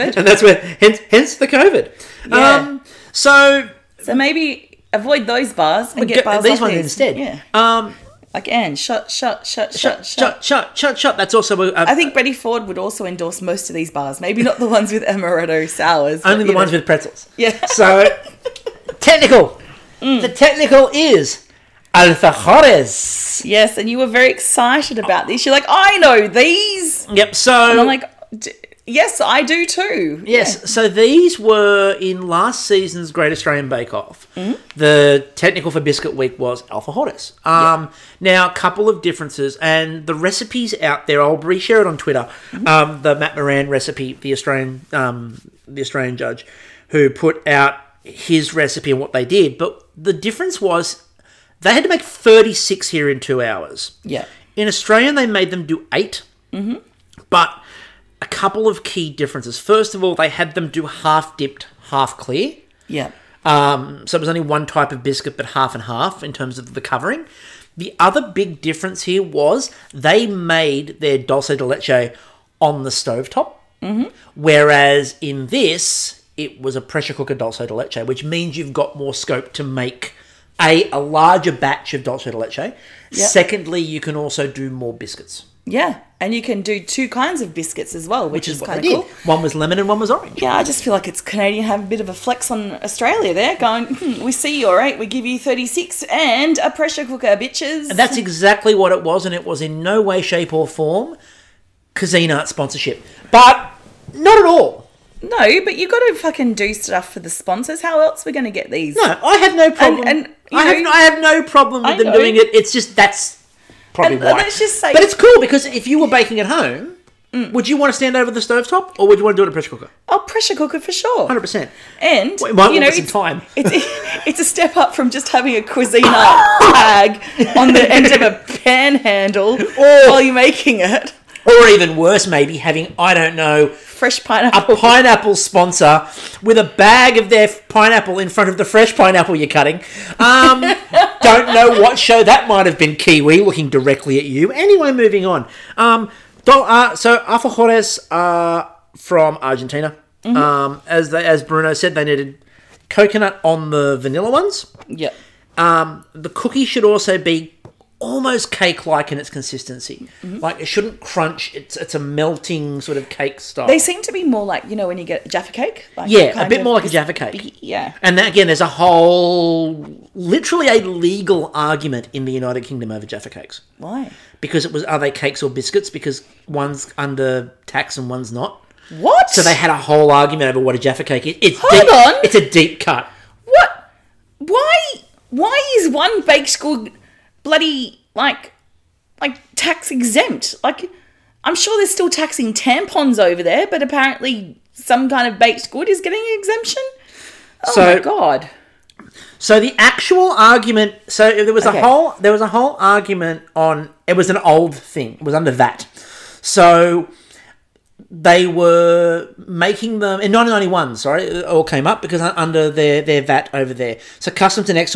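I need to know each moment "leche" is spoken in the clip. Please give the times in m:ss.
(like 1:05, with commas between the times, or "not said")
1:11, 1:17, 1:22.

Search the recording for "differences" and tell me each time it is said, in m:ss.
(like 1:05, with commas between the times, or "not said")
0:39, 0:50, 0:59, 1:08.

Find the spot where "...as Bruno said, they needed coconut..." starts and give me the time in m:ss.
2:31.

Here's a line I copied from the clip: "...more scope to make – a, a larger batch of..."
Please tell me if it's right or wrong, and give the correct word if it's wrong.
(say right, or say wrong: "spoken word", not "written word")
right.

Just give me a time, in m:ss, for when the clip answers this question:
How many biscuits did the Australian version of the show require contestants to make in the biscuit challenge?
0:55.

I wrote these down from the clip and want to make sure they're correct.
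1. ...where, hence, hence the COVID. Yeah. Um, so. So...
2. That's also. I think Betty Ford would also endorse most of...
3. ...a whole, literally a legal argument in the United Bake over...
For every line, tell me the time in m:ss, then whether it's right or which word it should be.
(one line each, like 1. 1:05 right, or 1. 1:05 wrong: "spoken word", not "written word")
1. 0:00 right
2. 0:11 right
3. 2:48 wrong: "Kingdom", not "Bake".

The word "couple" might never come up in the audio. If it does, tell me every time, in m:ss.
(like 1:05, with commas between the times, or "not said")
0:38, 0:58.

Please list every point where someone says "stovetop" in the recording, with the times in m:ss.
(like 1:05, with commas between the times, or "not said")
1:12, 1:58.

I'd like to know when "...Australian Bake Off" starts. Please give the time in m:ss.
0:33.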